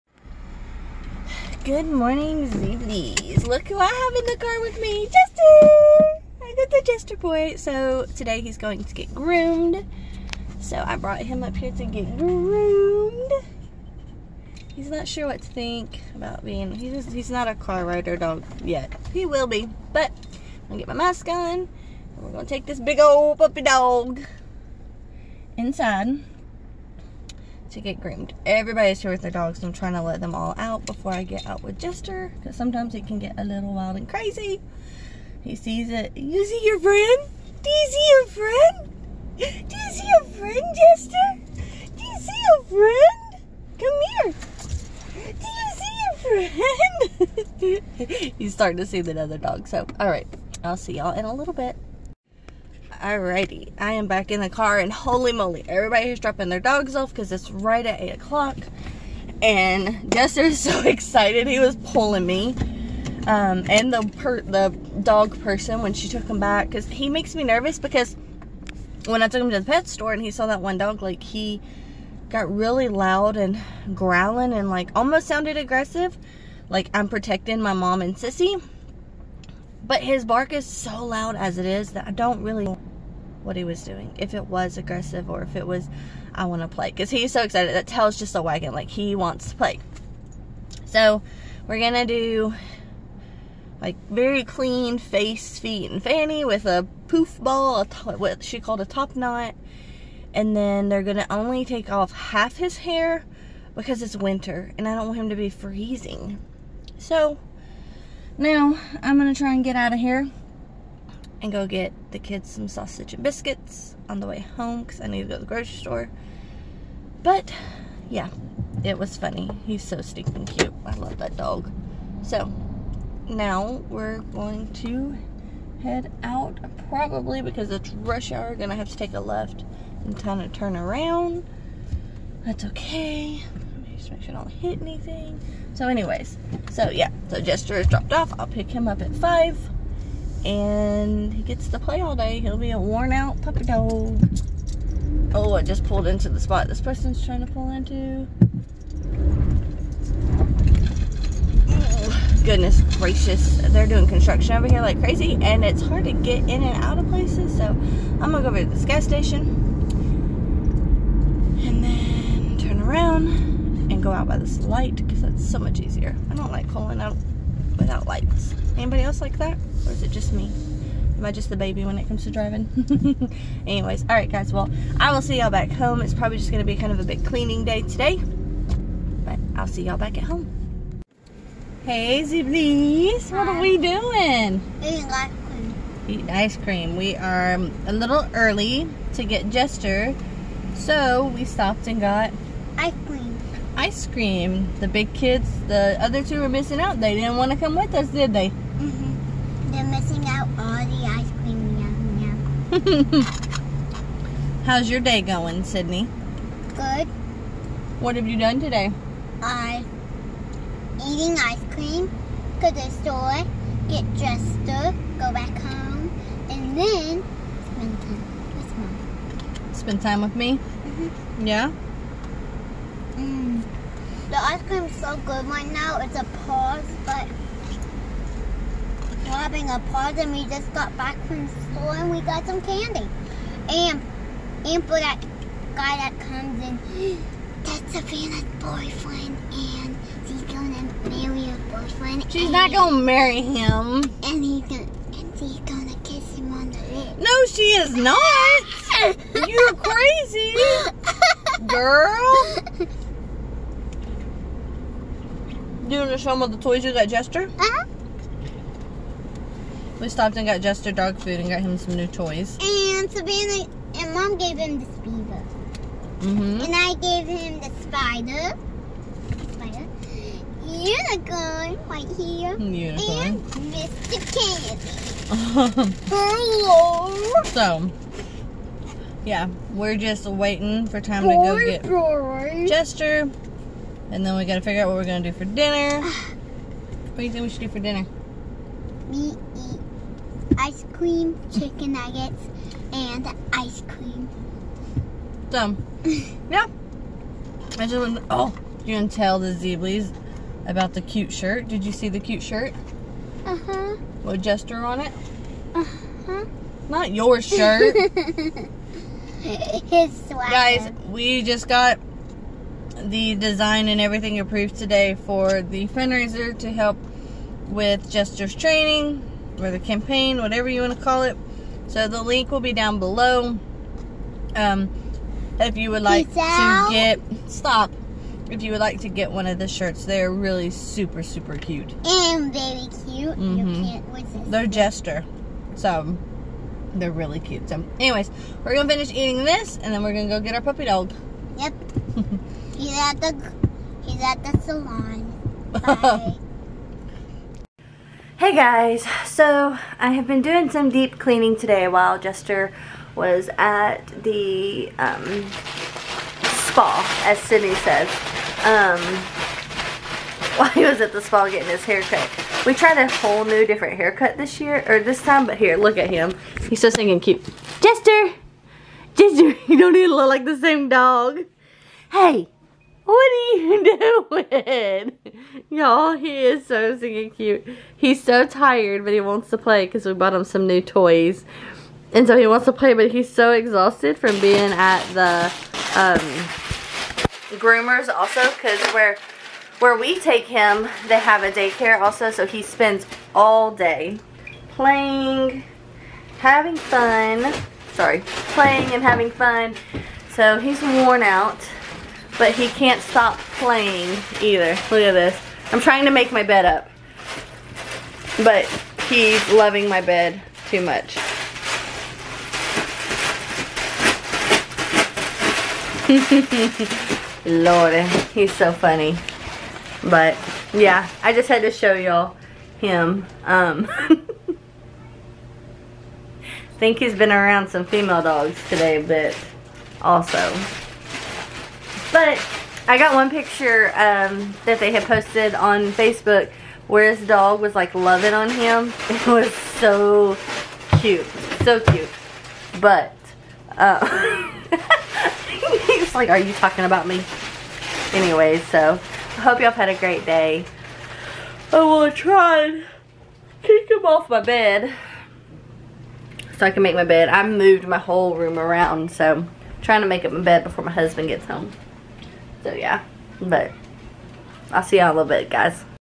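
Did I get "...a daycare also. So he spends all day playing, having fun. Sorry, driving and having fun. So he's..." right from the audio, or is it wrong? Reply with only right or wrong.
wrong.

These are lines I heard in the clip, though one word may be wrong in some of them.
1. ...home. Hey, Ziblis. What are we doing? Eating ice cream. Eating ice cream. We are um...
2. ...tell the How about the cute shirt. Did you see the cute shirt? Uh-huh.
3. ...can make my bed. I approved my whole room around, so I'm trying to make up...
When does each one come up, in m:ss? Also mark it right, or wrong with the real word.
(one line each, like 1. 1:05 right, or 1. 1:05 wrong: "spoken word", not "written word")
1. 3:00 right
2. 4:59 wrong: "Zeeblies", not "How"
3. 7:36 wrong: "moved", not "approved".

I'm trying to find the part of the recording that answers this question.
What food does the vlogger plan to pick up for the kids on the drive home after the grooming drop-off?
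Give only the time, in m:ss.
1:52.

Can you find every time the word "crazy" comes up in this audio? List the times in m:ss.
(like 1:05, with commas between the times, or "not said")
0:34, 2:34, 4:09.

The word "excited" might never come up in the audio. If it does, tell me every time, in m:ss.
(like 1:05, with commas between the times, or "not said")
1:00, 1:27.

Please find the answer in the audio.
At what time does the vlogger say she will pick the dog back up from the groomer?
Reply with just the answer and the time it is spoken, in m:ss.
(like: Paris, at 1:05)
5, at 2:19.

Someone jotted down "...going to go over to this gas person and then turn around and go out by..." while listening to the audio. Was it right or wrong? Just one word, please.
wrong.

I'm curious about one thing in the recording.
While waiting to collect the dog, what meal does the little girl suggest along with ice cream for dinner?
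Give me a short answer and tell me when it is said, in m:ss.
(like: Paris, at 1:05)
Chicken nuggets, at 4:51.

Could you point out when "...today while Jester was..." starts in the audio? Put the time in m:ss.
5:51.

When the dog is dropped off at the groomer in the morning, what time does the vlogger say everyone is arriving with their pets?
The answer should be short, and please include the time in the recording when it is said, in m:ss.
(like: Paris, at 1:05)
8 o'clock, at 0:57.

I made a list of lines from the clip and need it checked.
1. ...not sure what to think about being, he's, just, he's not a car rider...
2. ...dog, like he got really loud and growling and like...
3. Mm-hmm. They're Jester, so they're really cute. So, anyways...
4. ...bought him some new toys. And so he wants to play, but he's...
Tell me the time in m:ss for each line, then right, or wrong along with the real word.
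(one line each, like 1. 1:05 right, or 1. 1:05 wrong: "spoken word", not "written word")
1. 0:14 right
2. 1:10 right
3. 5:33 right
4. 6:20 right.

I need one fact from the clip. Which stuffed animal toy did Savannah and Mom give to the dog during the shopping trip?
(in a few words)
Beaver.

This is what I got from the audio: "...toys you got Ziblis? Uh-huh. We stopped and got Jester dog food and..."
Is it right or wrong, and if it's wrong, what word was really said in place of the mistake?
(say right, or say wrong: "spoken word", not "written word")
wrong: "Jester", not "Ziblis".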